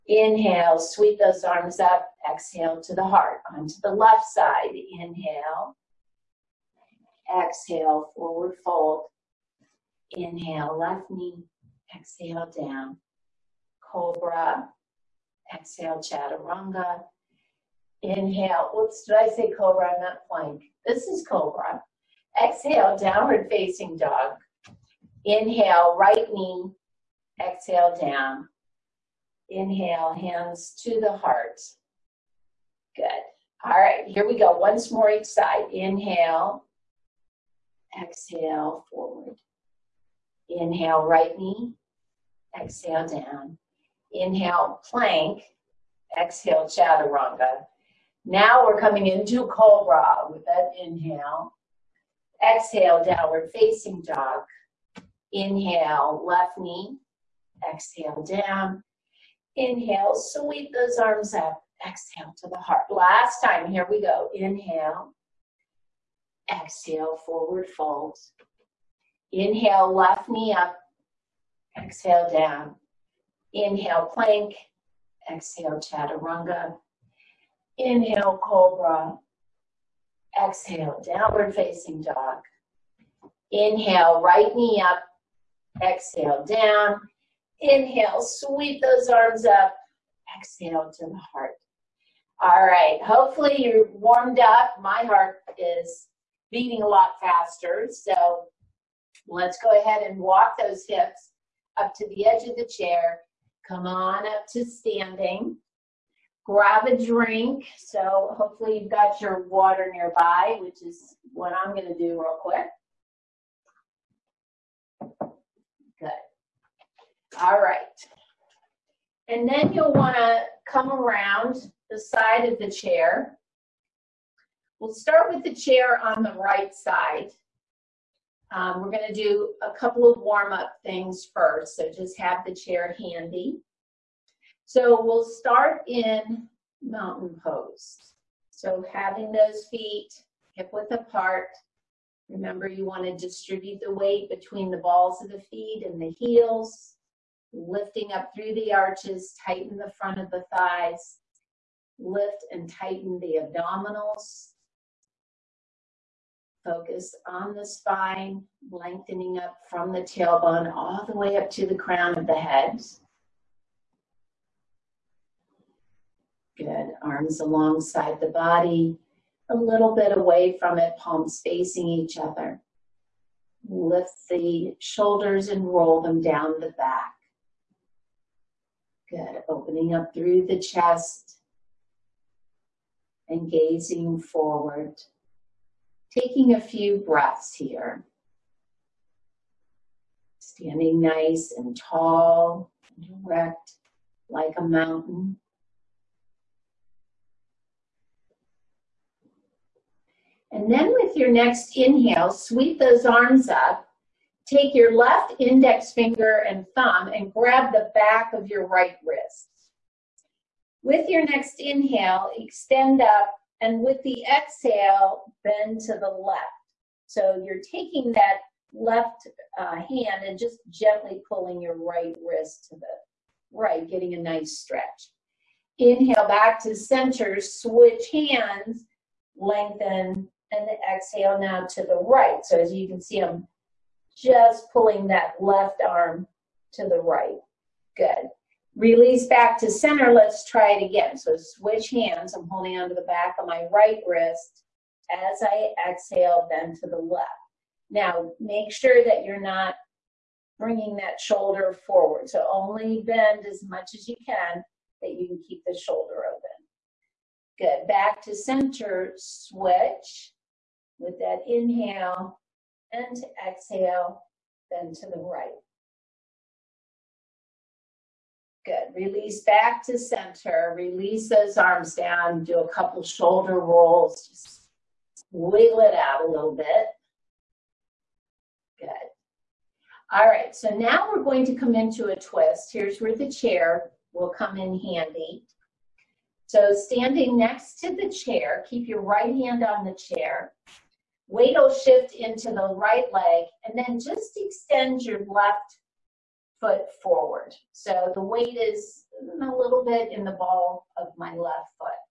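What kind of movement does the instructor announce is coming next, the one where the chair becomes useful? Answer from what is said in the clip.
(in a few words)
a twist.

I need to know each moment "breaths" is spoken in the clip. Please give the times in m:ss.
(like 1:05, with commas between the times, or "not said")
3:06.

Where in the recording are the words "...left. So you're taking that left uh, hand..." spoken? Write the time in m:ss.
3:36.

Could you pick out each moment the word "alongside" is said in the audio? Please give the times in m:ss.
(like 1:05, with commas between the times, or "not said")
2:47.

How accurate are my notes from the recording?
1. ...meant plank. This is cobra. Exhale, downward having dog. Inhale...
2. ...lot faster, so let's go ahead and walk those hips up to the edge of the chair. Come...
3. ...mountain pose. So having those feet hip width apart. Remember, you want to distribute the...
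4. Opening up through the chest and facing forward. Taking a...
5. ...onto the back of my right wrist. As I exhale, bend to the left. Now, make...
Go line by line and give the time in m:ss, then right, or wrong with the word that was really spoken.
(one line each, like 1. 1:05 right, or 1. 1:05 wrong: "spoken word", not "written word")
1. 0:20 wrong: "facing", not "having"
2. 1:36 right
3. 2:16 right
4. 2:59 wrong: "gazing", not "facing"
5. 4:02 right.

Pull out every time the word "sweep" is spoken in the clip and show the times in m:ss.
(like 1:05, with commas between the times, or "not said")
0:00, 1:00, 1:28, 3:22.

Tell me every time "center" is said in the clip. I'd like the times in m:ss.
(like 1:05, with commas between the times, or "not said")
3:46, 3:59, 4:18, 4:29.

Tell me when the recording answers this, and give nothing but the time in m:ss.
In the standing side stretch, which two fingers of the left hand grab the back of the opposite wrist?
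3:25.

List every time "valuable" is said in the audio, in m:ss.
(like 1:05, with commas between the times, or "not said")
not said.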